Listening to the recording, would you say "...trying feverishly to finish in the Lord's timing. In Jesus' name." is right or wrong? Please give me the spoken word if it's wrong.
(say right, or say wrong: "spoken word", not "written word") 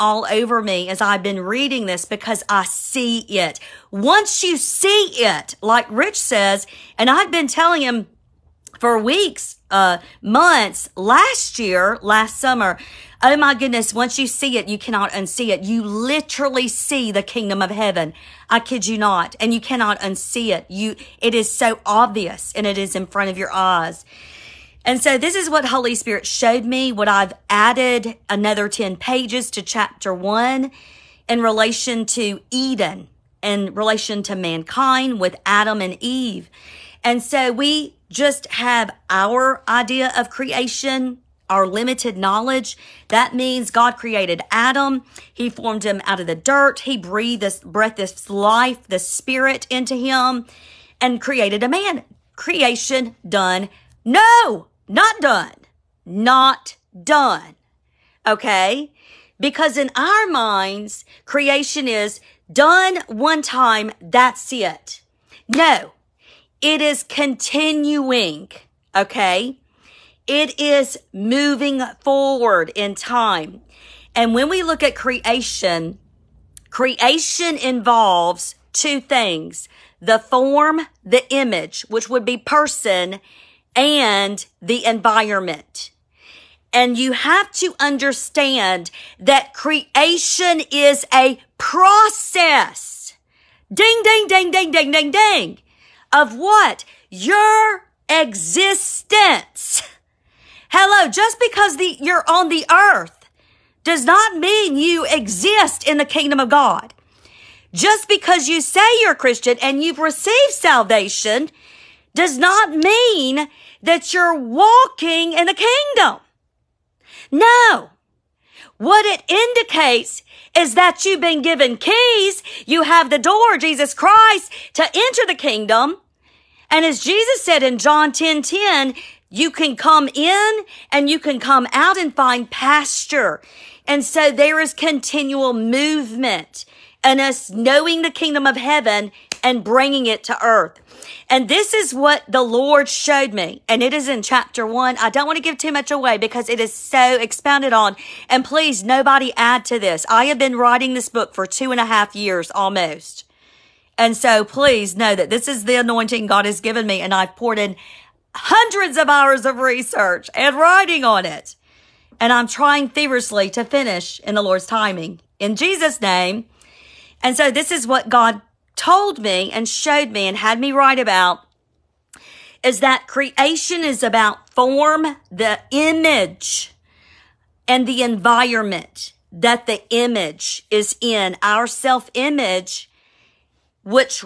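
right.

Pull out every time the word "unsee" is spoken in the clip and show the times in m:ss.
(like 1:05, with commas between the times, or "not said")
0:15, 0:19.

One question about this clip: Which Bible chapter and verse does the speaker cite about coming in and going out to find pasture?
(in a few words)
John 10:10.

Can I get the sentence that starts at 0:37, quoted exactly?
And so we just have our idea of creation, our limited knowledge.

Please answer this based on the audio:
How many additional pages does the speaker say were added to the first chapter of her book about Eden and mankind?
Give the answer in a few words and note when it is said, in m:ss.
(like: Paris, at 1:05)
10, at 0:28.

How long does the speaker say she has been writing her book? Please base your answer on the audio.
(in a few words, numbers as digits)
2.5 years.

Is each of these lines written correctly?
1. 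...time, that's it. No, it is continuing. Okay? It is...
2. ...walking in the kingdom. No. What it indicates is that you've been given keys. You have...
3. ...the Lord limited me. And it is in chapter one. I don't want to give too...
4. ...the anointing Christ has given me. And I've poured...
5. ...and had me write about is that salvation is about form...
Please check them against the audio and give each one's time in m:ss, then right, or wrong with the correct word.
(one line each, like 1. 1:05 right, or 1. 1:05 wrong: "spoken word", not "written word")
1. 1:03 right
2. 1:54 right
3. 2:22 wrong: "showed", not "limited"
4. 2:35 wrong: "God", not "Christ"
5. 2:50 wrong: "creation", not "salvation".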